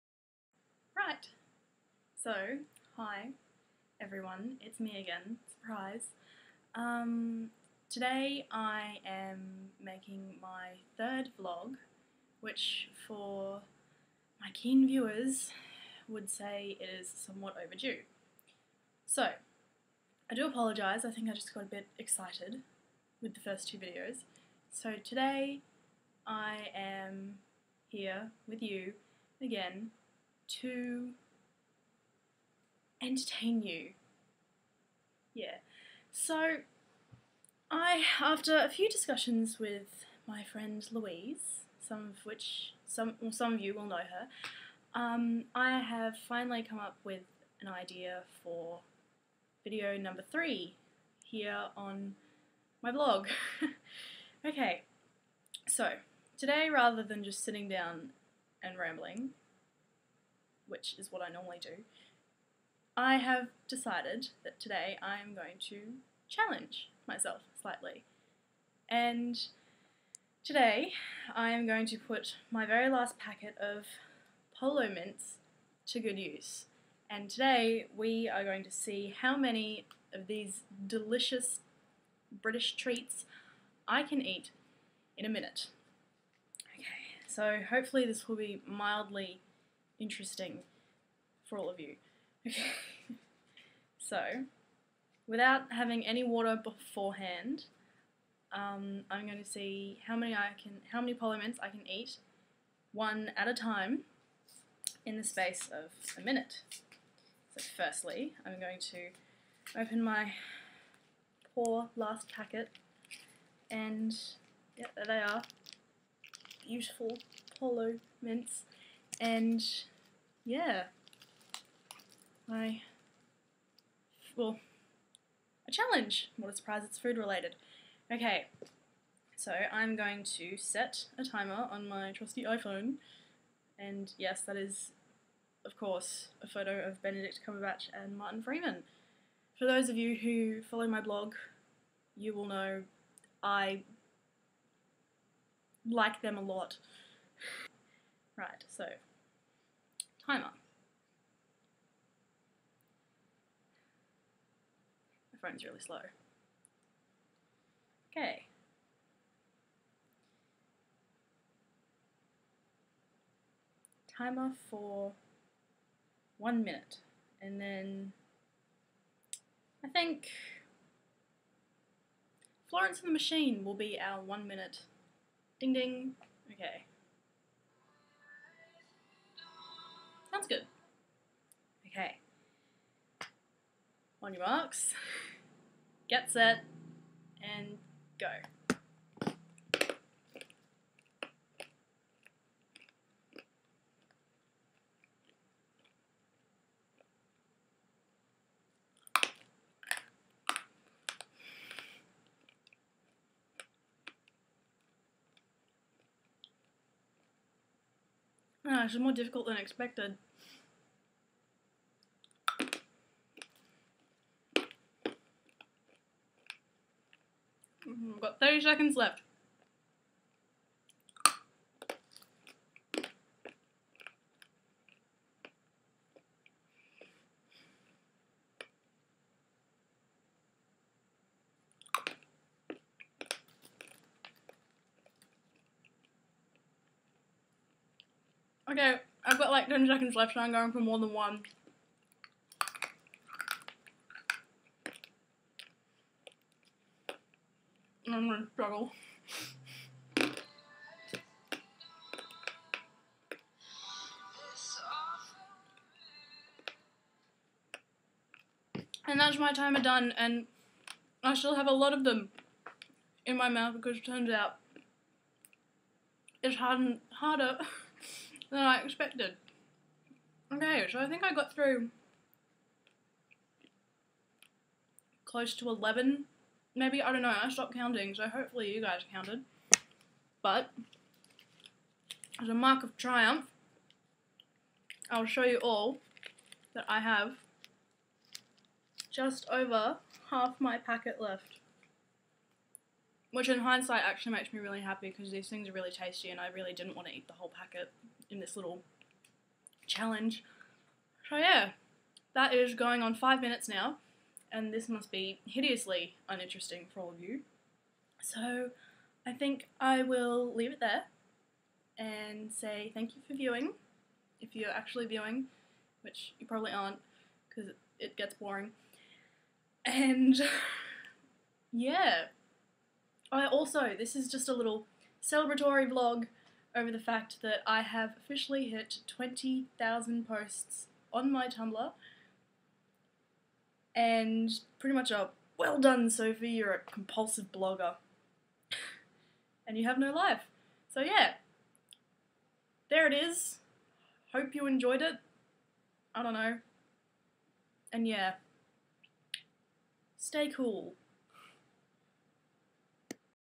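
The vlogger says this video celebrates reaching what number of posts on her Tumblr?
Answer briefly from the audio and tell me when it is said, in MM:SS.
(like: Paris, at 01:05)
20,000, at 05:29.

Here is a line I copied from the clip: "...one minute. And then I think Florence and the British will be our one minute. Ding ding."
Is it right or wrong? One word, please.
wrong.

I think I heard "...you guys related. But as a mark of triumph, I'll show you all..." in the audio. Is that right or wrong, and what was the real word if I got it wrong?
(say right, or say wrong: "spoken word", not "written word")
wrong: "counted", not "related".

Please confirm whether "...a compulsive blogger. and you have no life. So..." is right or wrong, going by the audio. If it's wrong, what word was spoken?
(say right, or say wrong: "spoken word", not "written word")
right.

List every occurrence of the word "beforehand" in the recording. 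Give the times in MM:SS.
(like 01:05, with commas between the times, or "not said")
01:36.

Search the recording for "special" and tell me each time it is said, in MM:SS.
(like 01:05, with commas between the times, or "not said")
not said.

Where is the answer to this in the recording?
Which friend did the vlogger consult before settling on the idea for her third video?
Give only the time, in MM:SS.
00:40.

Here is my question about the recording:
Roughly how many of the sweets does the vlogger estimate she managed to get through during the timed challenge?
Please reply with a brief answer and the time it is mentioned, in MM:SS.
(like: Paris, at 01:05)
11, at 04:35.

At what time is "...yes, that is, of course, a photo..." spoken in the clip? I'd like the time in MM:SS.
02:14.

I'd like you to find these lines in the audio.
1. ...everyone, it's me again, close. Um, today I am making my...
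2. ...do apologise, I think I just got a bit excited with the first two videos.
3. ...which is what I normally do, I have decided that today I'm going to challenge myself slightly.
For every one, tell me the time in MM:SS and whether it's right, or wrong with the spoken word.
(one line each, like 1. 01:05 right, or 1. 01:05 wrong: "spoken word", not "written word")
1. 00:03 wrong: "surprise", not "close"
2. 00:20 right
3. 01:00 right.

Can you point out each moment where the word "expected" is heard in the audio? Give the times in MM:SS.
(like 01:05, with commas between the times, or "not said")
03:29, 04:28.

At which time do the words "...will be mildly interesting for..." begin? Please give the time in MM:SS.
01:28.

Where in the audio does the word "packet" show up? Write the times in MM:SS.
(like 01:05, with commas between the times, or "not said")
01:13, 01:52, 04:50, 04:57.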